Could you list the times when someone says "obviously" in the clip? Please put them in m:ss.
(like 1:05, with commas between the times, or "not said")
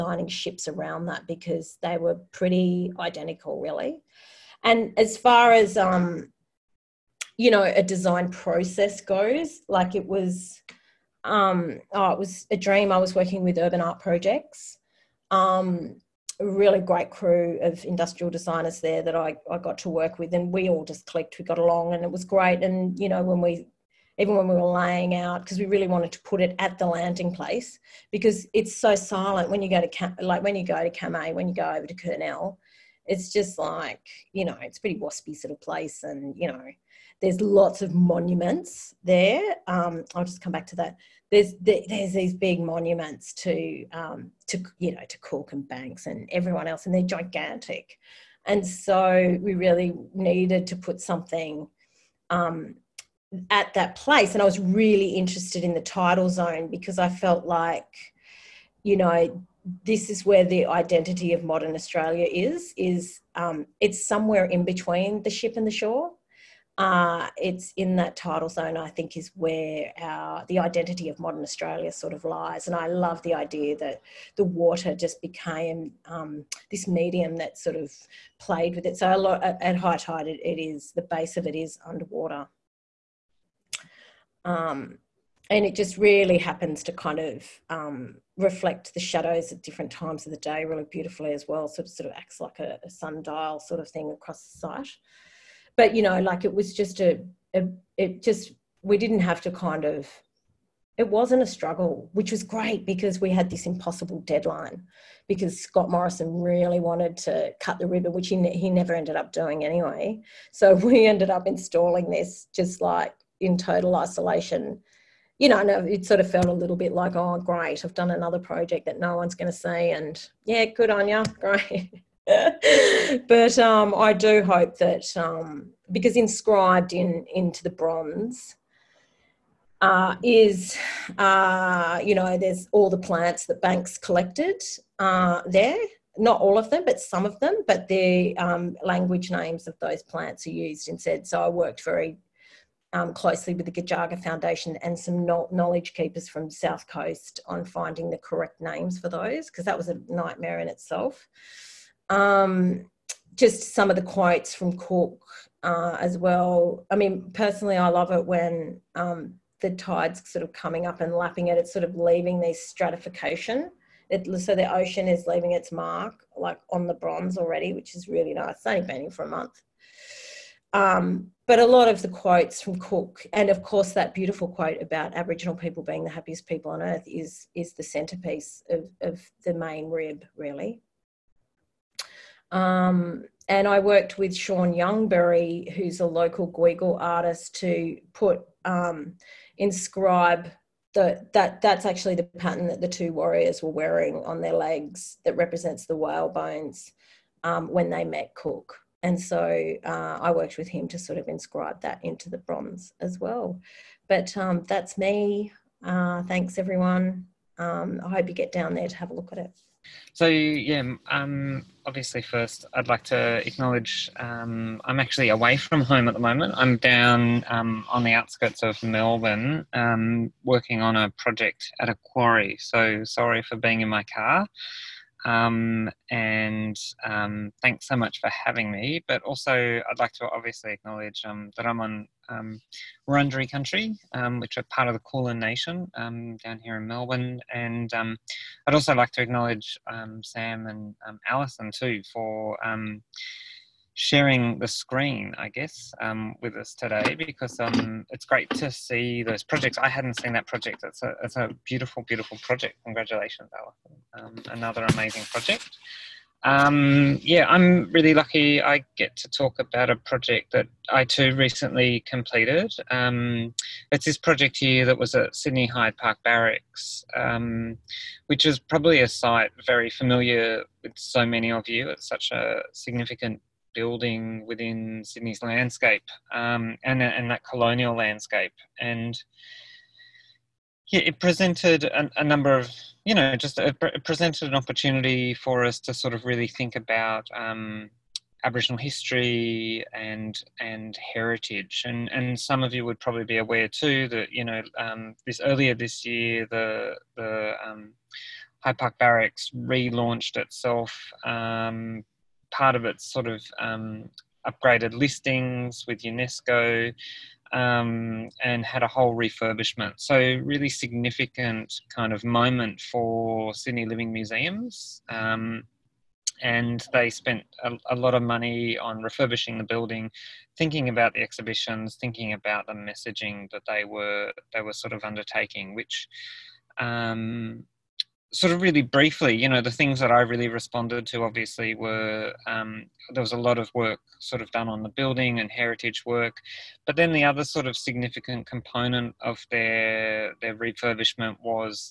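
3:31, 3:50, 5:31.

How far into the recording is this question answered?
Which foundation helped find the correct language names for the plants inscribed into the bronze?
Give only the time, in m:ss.
2:23.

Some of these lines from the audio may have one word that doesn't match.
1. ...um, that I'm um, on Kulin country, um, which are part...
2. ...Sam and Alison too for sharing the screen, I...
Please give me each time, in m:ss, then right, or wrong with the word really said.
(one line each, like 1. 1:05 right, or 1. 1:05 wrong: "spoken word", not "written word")
1. 3:51 wrong: "Wurundjeri", not "Kulin"
2. 4:00 right.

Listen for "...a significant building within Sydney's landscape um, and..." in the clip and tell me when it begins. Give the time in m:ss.
4:32.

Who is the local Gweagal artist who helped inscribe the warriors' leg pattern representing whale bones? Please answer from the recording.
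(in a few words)
Sean Youngberry.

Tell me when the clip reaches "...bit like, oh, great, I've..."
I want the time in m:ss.
1:56.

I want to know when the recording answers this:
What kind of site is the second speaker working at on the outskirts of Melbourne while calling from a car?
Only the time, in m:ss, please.
3:42.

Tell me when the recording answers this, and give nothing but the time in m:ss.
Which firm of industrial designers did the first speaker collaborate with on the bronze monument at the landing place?
0:13.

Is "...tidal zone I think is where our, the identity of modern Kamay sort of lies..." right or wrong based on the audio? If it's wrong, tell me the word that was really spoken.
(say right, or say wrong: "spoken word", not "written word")
wrong: "Australia", not "Kamay".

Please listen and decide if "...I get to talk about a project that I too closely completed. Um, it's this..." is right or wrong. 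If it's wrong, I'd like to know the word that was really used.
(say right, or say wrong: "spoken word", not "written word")
wrong: "recently", not "closely".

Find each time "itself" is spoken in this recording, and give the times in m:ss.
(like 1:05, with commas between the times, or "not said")
2:30, 5:00.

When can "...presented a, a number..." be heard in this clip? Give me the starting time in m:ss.
4:41.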